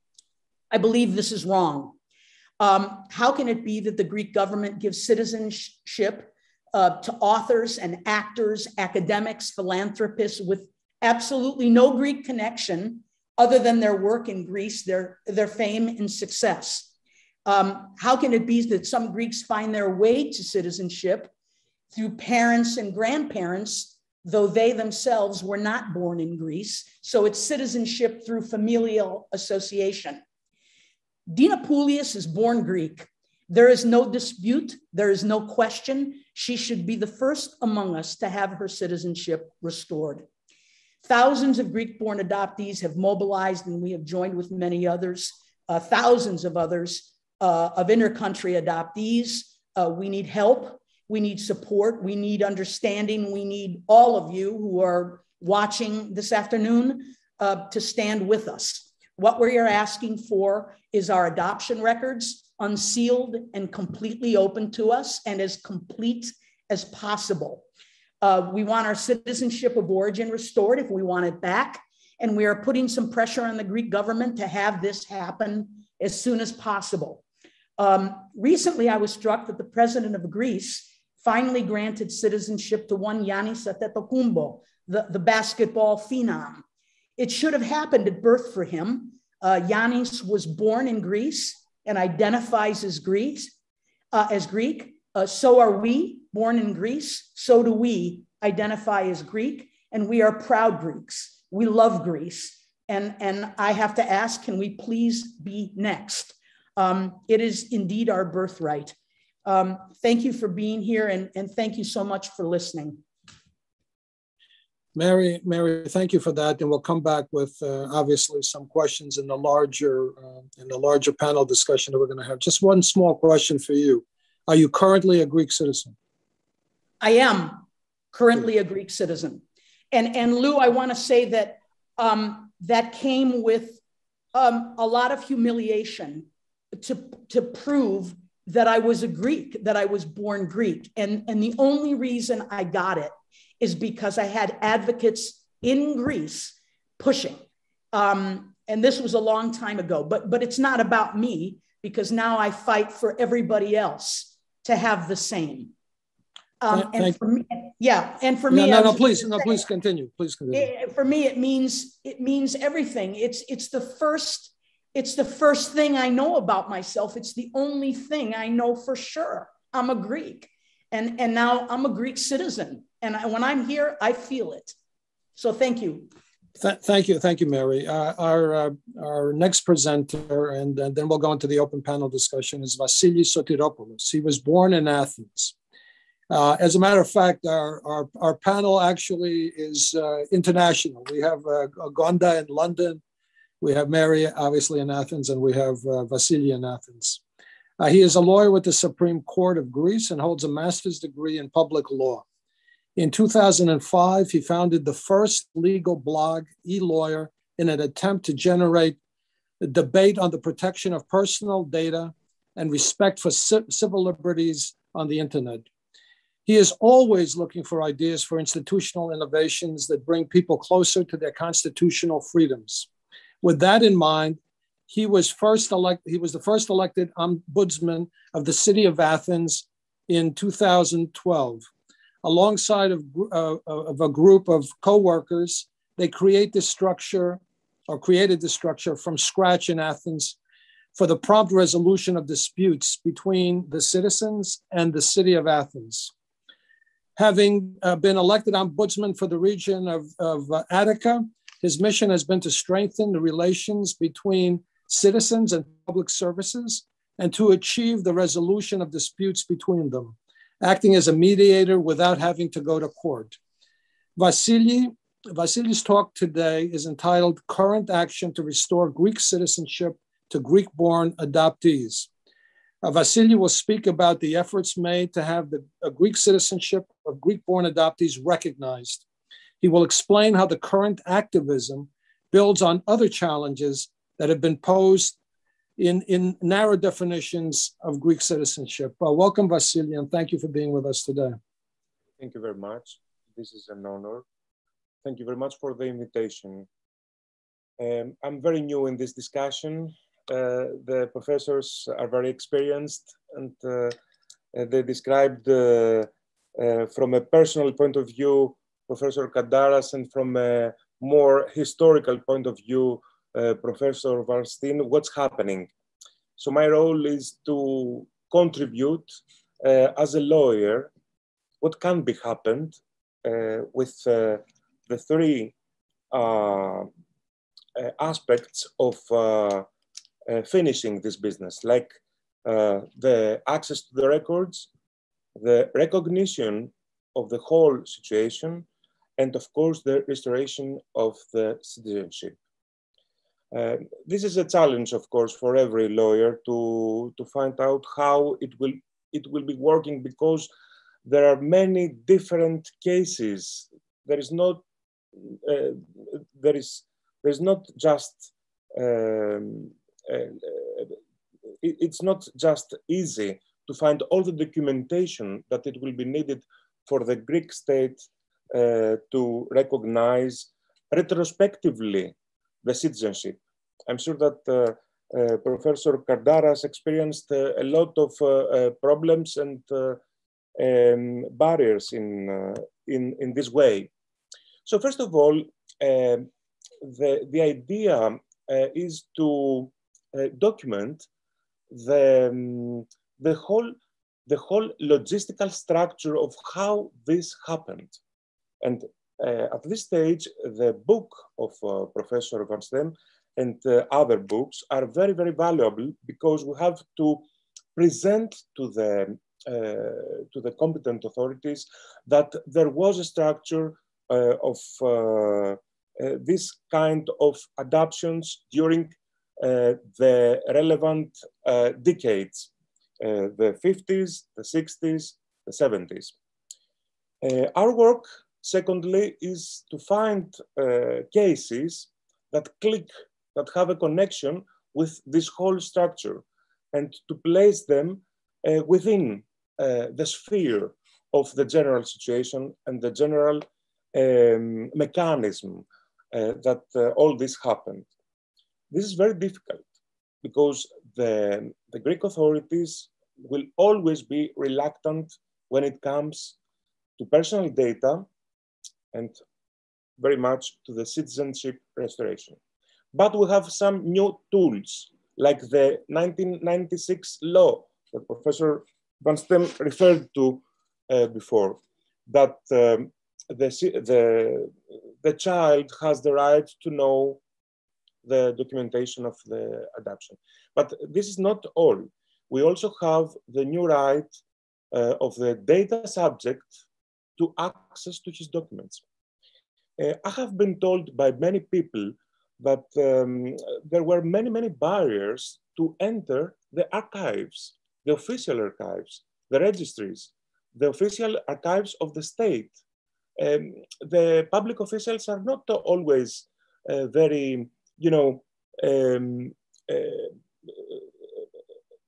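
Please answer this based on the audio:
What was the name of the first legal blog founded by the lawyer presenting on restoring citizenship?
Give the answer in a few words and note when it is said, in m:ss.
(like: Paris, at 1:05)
eLawyer, at 3:26.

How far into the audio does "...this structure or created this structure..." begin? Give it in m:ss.
3:56.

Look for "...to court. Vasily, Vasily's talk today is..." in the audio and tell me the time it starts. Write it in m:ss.
4:22.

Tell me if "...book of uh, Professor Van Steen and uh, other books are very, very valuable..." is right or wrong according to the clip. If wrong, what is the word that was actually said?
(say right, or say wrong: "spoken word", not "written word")
right.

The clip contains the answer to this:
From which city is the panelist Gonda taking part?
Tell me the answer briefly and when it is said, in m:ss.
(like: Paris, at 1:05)
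London, at 3:12.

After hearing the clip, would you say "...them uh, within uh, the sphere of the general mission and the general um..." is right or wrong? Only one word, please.
wrong.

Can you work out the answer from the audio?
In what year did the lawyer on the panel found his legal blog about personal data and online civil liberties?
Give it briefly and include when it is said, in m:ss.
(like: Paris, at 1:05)
2005, at 3:23.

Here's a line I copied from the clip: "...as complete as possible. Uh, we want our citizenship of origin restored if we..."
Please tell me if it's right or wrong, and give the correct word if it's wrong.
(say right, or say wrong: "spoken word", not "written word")
right.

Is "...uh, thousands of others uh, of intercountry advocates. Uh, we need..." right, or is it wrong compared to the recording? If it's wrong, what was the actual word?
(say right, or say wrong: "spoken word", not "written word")
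wrong: "adoptees", not "advocates".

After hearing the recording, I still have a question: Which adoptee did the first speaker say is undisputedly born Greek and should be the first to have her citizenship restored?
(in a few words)
Dina Dinopulius.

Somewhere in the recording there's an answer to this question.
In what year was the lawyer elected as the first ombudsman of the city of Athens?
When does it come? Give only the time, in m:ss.
3:50.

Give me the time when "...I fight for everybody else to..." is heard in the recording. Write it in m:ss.
2:32.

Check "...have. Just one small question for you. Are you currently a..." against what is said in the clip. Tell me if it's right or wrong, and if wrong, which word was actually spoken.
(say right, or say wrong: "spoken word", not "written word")
right.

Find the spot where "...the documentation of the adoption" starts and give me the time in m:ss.
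7:58.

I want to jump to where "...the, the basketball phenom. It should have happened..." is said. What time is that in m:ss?
1:24.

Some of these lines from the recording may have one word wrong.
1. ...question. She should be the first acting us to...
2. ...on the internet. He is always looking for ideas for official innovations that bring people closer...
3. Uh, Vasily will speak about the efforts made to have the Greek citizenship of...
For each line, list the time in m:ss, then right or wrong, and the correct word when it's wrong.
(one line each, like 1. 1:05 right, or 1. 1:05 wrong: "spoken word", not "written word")
1. 0:35 wrong: "among", not "acting"
2. 3:34 wrong: "institutional", not "official"
3. 4:32 right.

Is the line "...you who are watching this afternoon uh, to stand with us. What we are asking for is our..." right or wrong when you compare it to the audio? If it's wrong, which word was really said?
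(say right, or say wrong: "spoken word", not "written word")
right.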